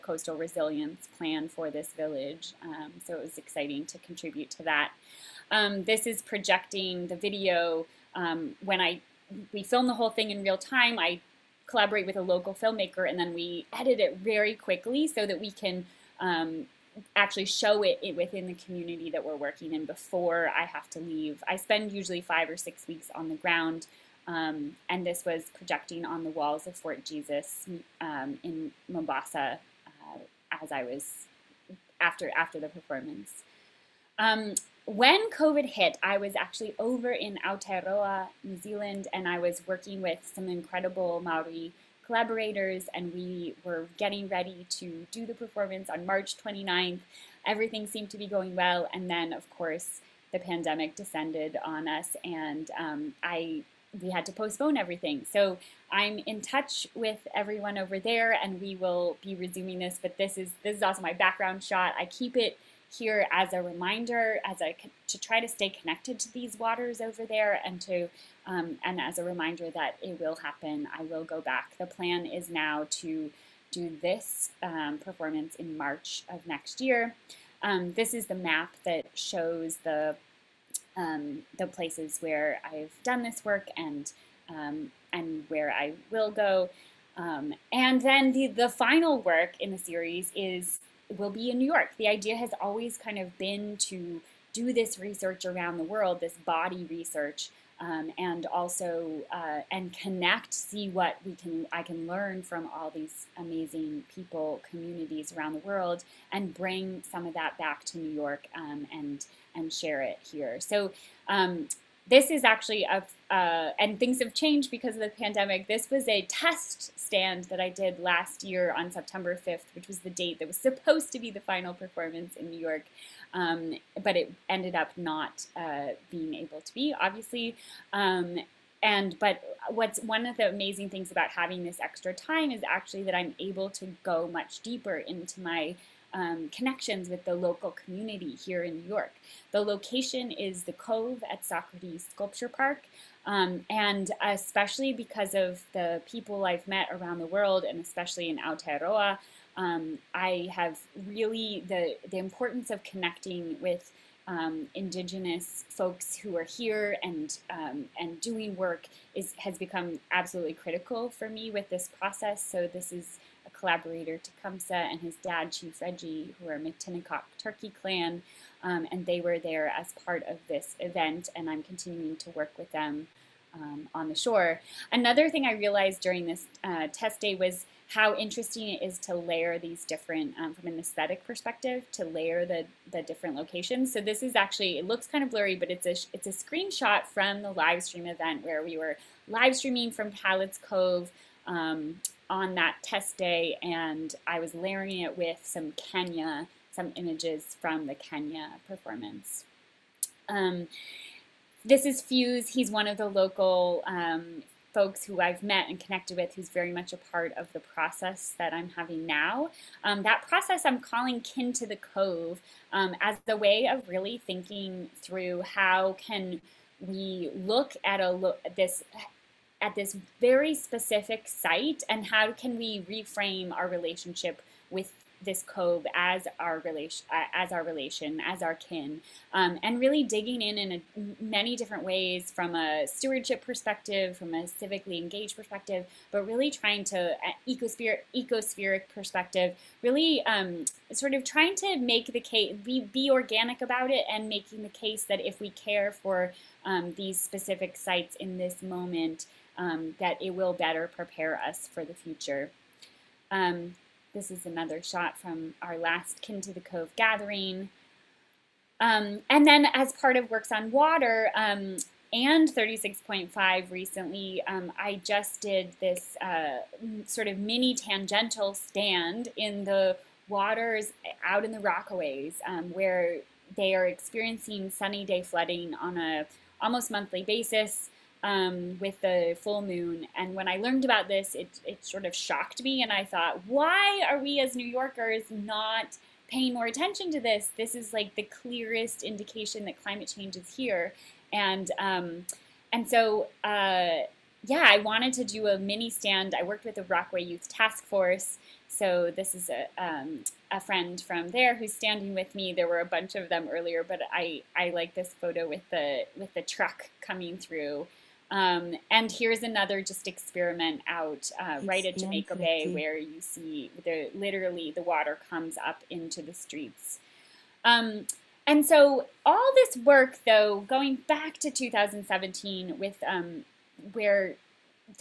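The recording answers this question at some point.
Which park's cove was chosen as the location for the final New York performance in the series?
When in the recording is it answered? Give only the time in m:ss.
2:21.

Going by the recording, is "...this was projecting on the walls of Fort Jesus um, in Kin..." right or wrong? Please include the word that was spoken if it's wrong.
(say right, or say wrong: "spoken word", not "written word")
wrong: "Mombasa", not "Kin".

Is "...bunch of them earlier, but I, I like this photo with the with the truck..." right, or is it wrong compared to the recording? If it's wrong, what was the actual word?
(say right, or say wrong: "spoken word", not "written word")
right.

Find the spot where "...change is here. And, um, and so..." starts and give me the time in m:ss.
4:50.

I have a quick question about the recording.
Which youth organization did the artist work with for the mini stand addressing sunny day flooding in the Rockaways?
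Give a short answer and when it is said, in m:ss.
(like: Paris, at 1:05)
Rockaway Youth Task Force, at 4:56.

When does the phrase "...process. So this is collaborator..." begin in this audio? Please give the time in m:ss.
2:41.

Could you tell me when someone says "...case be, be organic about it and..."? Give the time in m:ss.
4:02.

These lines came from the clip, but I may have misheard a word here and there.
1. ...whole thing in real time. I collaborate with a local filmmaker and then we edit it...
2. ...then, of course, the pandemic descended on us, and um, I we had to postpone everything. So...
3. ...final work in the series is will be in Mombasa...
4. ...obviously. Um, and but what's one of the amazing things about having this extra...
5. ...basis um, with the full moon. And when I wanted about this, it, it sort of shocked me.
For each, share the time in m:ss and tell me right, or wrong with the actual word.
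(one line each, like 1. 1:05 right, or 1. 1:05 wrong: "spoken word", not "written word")
1. 0:09 right
2. 0:49 right
3. 1:28 wrong: "New", not "Mombasa"
4. 2:06 right
5. 4:37 wrong: "learned", not "wanted".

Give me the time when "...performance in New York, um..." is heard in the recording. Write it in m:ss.
2:01.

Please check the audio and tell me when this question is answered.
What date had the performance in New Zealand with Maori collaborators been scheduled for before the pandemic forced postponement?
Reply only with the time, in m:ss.
0:46.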